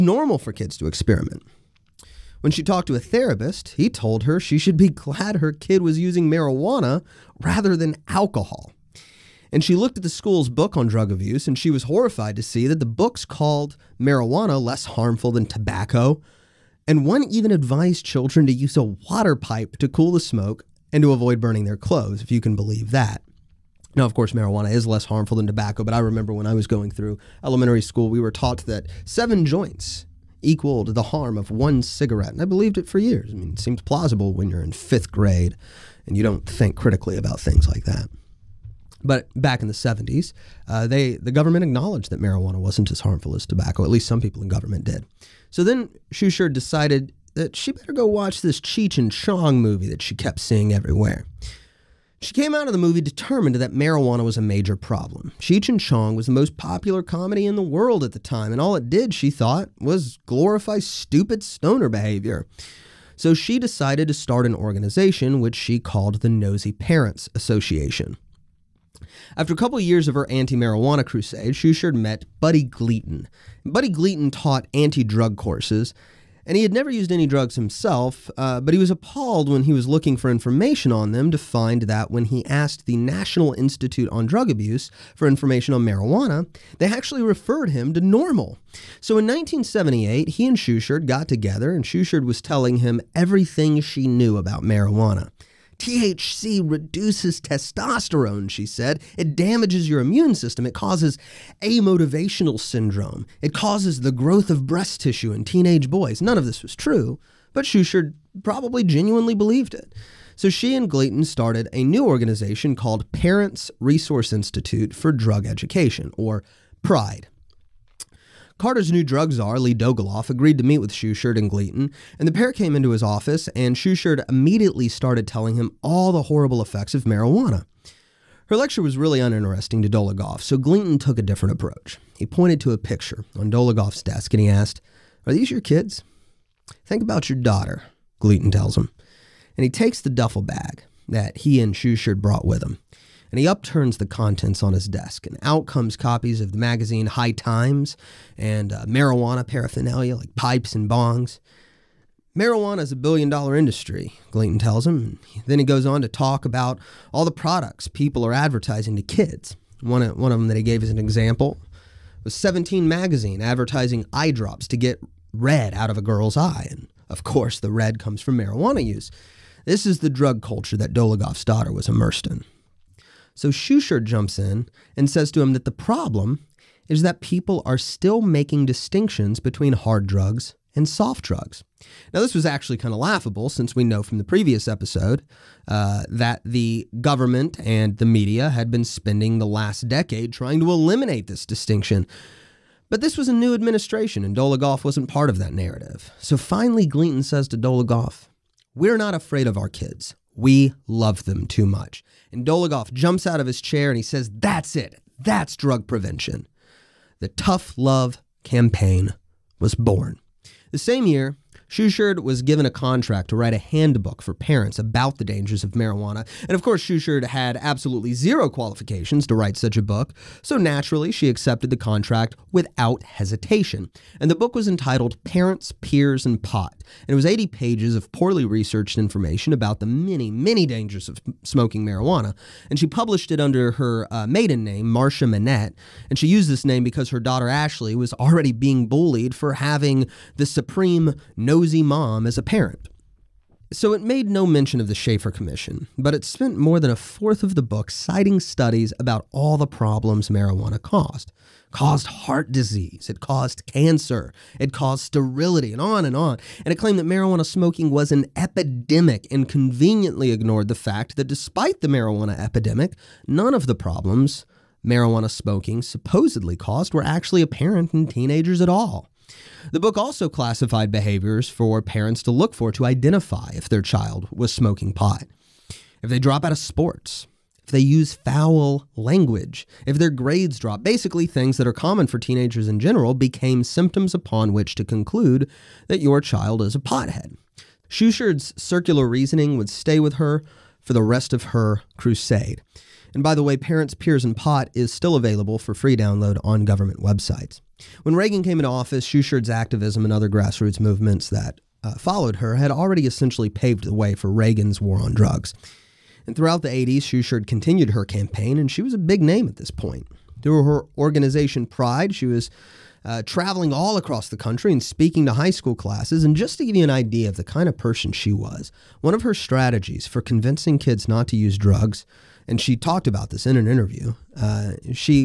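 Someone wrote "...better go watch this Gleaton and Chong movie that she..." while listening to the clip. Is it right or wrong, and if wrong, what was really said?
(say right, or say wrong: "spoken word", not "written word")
wrong: "Cheech", not "Gleaton".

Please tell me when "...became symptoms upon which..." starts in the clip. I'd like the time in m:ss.
4:43.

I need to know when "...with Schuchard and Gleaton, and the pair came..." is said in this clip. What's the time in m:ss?
2:00.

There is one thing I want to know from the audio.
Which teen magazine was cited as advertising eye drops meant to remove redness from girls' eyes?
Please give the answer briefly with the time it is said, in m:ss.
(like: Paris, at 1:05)
17 Magazine, at 2:42.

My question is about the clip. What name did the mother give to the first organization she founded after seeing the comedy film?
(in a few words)
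Nosy Parents Association.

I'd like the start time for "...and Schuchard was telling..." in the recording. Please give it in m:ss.
1:31.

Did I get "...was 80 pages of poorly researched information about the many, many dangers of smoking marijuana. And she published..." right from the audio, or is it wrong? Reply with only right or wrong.
right.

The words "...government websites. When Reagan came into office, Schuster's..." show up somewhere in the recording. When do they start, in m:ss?
4:56.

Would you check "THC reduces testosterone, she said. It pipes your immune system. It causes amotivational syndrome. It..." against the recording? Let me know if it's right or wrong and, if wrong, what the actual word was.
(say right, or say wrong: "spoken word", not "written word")
wrong: "damages", not "pipes".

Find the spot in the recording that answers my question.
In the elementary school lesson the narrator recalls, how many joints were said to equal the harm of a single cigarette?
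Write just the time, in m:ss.
0:29.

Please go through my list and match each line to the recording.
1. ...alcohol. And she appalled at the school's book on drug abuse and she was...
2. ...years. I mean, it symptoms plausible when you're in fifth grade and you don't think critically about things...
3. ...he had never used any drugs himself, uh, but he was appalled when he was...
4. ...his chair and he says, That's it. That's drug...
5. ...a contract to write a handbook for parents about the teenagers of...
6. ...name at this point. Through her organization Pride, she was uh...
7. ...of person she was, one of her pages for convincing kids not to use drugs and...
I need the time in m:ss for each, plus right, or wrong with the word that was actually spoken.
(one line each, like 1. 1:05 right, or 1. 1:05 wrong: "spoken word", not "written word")
1. 0:08 wrong: "looked", not "appalled"
2. 0:32 wrong: "seems", not "symptoms"
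3. 1:16 right
4. 3:23 right
5. 3:32 wrong: "dangers", not "teenagers"
6. 5:09 right
7. 5:17 wrong: "strategies", not "pages".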